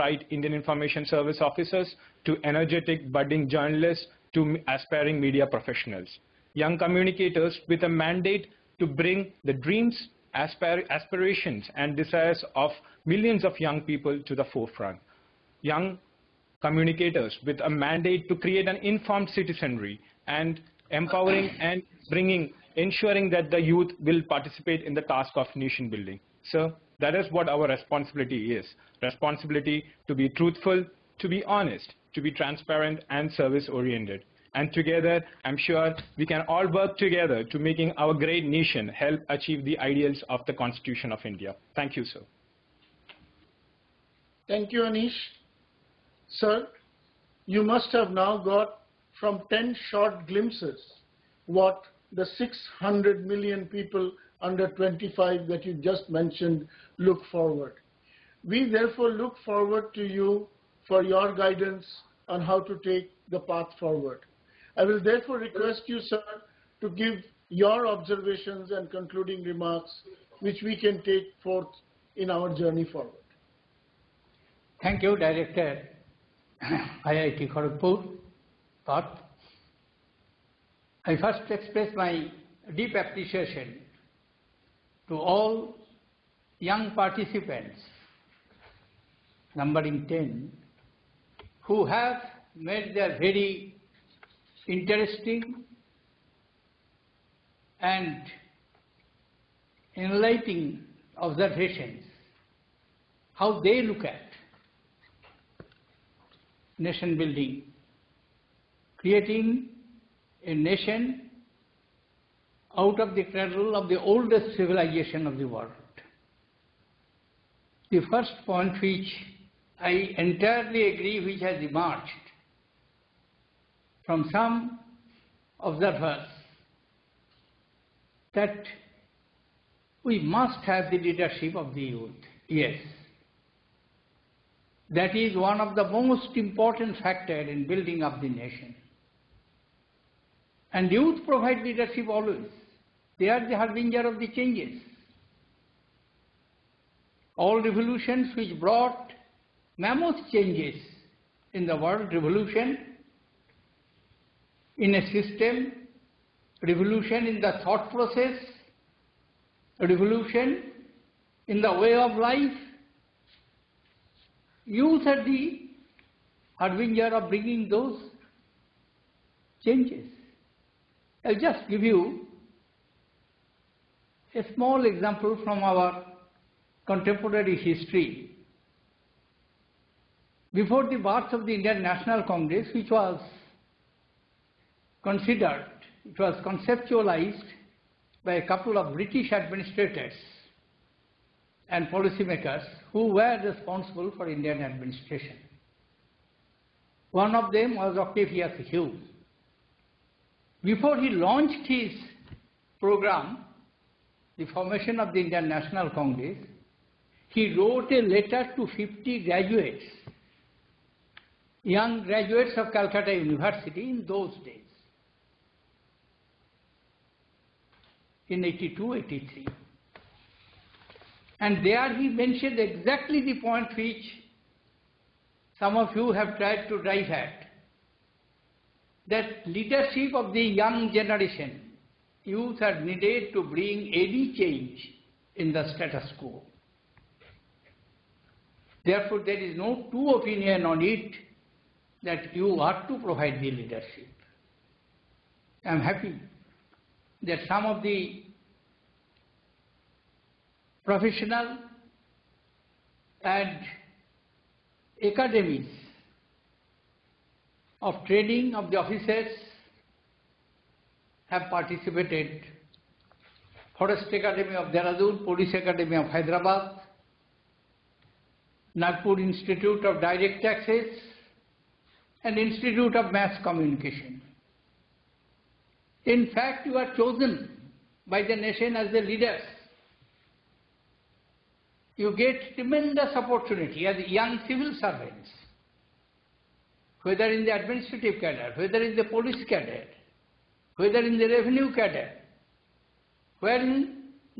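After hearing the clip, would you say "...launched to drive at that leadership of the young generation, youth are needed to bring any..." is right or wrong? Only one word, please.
wrong.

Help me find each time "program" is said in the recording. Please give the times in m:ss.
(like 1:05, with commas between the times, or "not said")
3:22.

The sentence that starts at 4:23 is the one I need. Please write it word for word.
Forest Academy of Dehradun, Police Academy of Hyderabad, Nagpur Institute of Direct Taxes, and Institute of Mass Communication.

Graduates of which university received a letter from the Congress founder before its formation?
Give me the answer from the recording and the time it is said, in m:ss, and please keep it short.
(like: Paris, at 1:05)
Calcutta University, at 3:32.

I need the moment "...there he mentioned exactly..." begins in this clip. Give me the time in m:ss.
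3:41.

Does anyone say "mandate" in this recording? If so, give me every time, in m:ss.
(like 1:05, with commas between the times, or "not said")
0:07, 0:17.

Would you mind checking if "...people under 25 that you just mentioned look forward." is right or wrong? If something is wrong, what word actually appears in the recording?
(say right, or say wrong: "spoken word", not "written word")
right.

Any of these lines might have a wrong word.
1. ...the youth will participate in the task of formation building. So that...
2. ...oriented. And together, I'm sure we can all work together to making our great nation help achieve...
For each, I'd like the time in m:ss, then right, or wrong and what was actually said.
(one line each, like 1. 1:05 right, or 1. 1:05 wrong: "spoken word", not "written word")
1. 0:23 wrong: "nation", not "formation"
2. 0:33 right.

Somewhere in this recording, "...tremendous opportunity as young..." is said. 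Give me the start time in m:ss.
4:42.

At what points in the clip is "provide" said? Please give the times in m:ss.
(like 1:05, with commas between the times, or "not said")
2:21, 4:02.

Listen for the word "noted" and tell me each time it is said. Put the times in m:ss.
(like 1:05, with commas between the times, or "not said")
not said.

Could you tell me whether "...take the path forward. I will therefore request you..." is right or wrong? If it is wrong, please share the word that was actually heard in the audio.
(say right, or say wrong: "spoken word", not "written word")
right.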